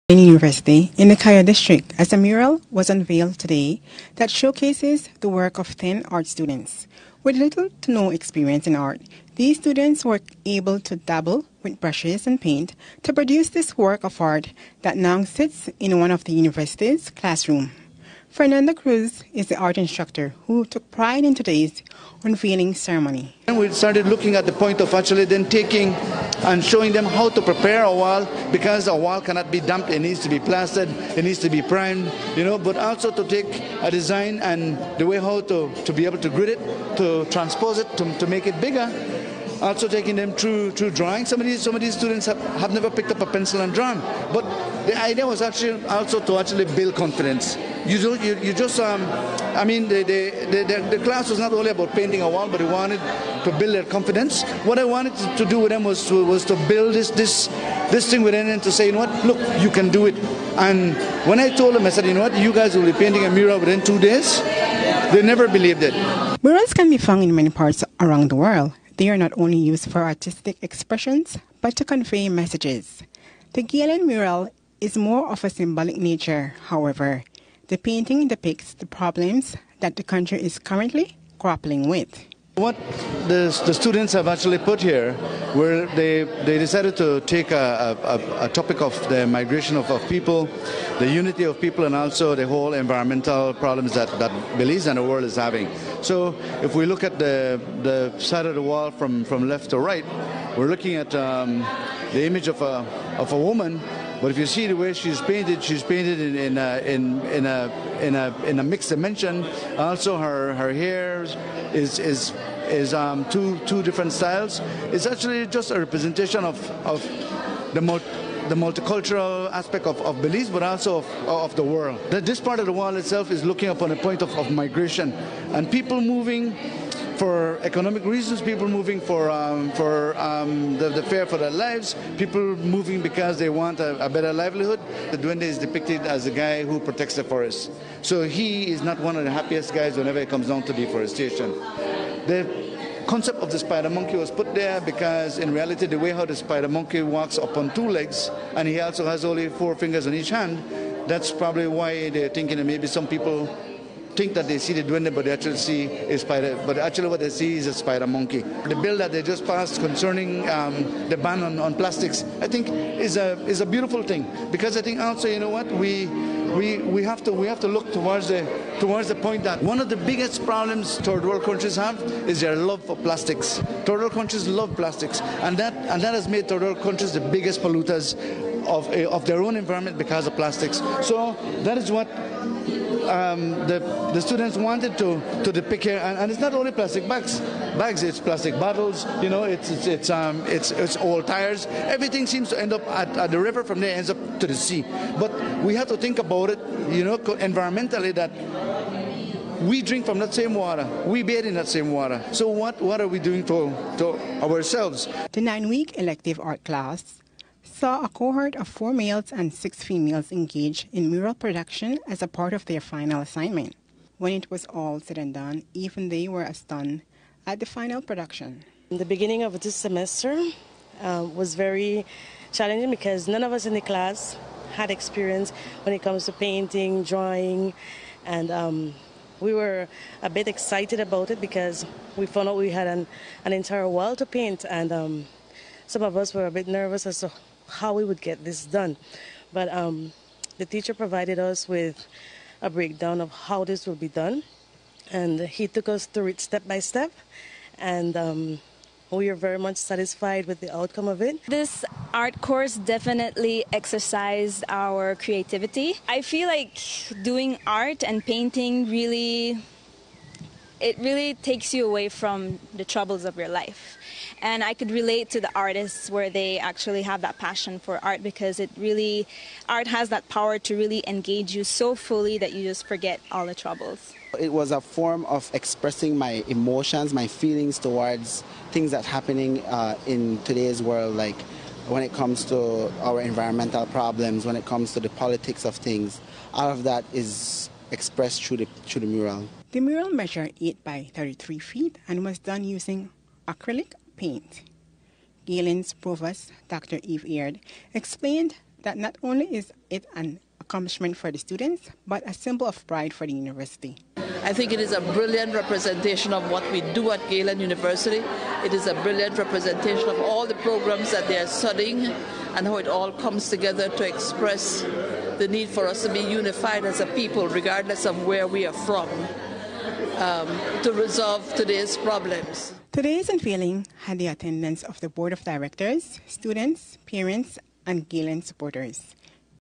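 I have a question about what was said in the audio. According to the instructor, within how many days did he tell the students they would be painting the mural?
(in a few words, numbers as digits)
2.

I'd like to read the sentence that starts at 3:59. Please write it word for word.
But um, the teacher provided us with a breakdown of how this will be done.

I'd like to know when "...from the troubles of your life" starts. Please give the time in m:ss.
4:22.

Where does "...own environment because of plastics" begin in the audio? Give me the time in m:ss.
2:59.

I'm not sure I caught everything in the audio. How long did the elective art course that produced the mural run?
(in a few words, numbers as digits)
9 weeks.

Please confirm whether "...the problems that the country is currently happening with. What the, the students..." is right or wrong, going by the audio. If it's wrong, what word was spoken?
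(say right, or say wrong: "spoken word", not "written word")
wrong: "grappling", not "happening".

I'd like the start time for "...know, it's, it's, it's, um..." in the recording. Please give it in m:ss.
3:09.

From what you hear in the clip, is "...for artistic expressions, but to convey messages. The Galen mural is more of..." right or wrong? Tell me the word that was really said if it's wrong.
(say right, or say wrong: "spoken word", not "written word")
right.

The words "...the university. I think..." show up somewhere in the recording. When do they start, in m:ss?
5:03.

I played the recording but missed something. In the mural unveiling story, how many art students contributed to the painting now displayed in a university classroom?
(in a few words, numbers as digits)
10.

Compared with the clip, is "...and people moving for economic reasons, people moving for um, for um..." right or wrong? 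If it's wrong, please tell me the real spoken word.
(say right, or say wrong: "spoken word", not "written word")
right.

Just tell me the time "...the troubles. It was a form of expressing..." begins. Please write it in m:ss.
4:33.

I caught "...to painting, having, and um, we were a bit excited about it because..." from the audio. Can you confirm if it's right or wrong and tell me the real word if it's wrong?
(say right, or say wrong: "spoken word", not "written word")
wrong: "drawing", not "having".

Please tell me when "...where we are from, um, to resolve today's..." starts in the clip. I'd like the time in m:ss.
5:18.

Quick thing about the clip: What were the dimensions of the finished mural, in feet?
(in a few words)
8 by 33 feet.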